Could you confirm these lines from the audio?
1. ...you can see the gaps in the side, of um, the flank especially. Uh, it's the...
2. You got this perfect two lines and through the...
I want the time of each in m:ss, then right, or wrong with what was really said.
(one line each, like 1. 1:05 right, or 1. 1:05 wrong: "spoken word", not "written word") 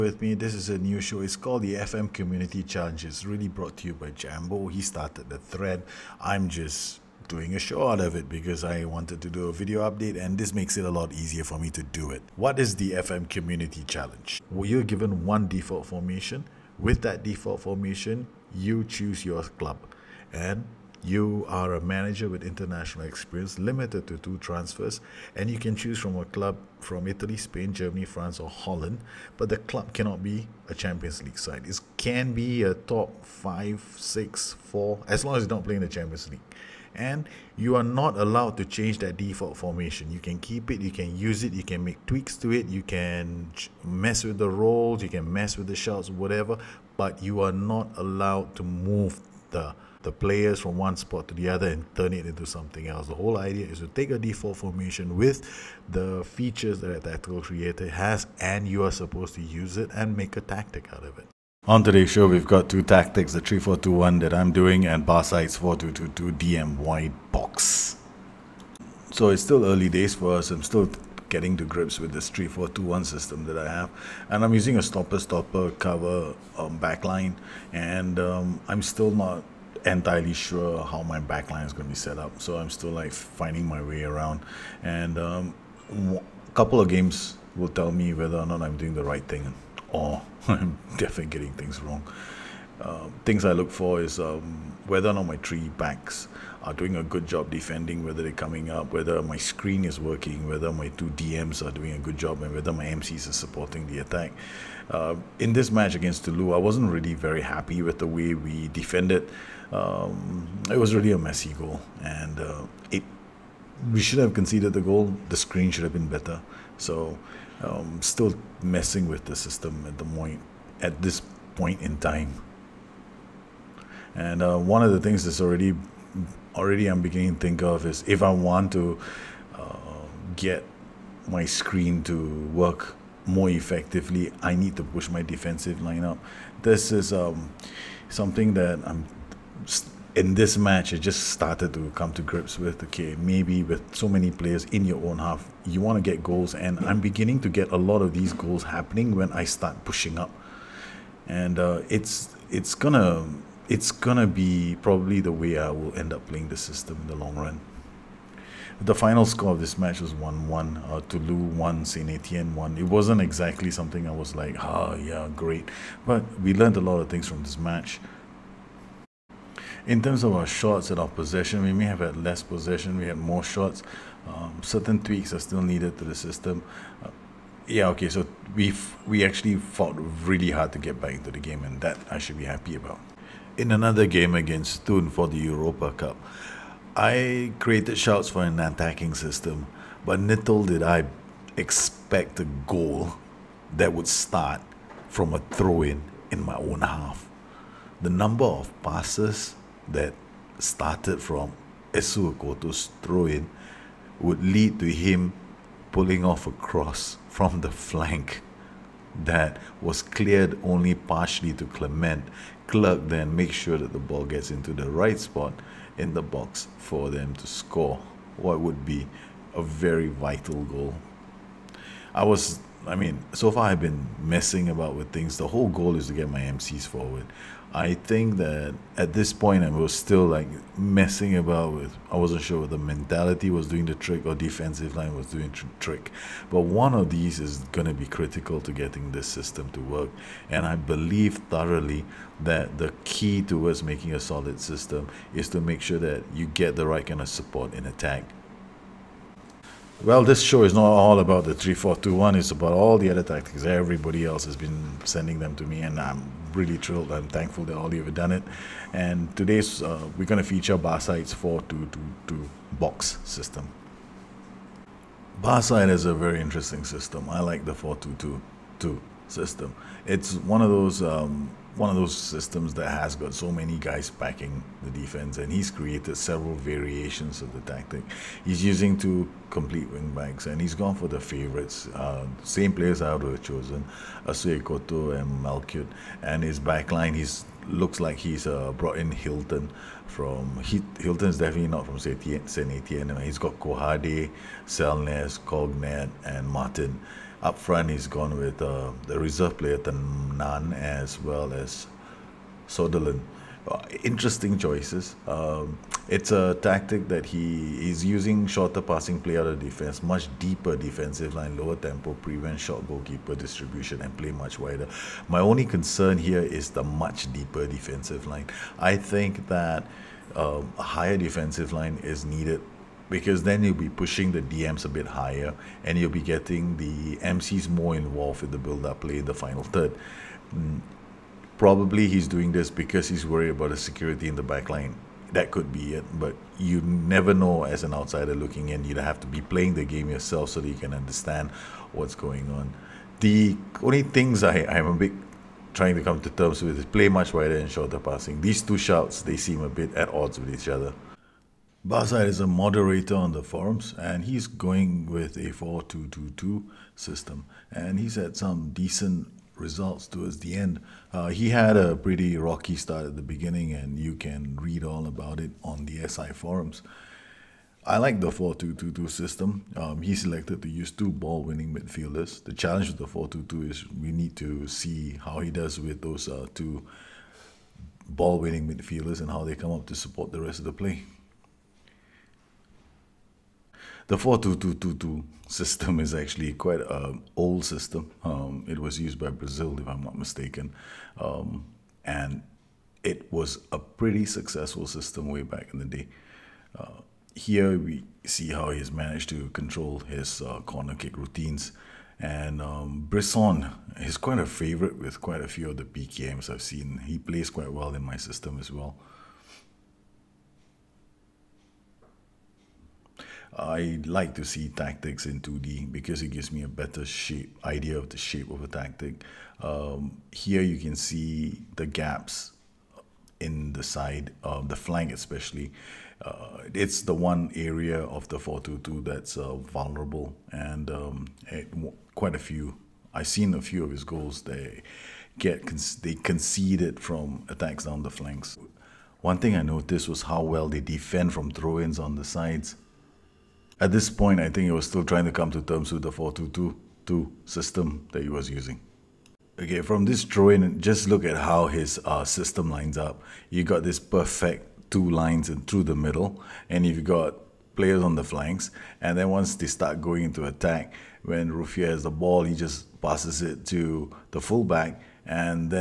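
1. 7:00 right
2. 7:33 right.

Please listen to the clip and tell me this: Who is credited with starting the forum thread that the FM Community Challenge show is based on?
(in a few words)
Jambo.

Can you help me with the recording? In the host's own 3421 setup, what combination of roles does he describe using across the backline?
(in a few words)
stopper stopper cover.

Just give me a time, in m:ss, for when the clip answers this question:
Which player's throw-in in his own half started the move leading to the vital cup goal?
3:21.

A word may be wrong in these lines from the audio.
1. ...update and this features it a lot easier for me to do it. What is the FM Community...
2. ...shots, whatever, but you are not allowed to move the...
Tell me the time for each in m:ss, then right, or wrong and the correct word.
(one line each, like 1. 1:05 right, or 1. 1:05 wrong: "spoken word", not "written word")
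1. 0:09 wrong: "makes", not "features"
2. 0:45 right.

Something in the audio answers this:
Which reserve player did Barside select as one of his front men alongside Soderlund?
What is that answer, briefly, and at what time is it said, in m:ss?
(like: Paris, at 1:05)
Tanan, at 4:59.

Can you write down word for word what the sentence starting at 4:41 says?
Uh, same players I would have chosen, Assou-Ekotto and Malcuit.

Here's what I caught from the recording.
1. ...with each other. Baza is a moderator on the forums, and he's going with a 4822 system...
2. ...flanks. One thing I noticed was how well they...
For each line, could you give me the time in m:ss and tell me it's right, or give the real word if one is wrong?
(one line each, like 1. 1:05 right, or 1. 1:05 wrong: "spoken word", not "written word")
1. 5:50 wrong: "4222", not "4822"
2. 7:18 right.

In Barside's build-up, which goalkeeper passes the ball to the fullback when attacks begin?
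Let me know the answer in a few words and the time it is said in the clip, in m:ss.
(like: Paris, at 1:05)
Ruffier, at 7:41.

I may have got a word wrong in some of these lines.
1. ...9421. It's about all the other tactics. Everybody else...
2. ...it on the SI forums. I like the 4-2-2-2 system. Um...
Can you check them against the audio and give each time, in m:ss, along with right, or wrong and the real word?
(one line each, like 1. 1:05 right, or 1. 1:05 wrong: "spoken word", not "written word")
1. 4:11 wrong: "3421", not "9421"
2. 6:05 right.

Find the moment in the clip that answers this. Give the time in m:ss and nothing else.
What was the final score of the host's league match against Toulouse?
2:40.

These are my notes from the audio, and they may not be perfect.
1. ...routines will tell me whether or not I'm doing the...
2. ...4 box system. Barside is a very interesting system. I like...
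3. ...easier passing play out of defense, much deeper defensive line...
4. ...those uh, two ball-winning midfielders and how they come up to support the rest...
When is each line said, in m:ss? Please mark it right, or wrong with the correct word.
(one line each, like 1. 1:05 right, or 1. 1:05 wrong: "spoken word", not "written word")
1. 1:26 wrong: "games", not "routines"
2. 4:22 wrong: "2", not "4"
3. 5:08 wrong: "shorter", not "easier"
4. 6:16 right.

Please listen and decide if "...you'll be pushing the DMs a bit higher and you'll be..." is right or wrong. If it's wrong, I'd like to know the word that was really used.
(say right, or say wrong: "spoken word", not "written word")
right.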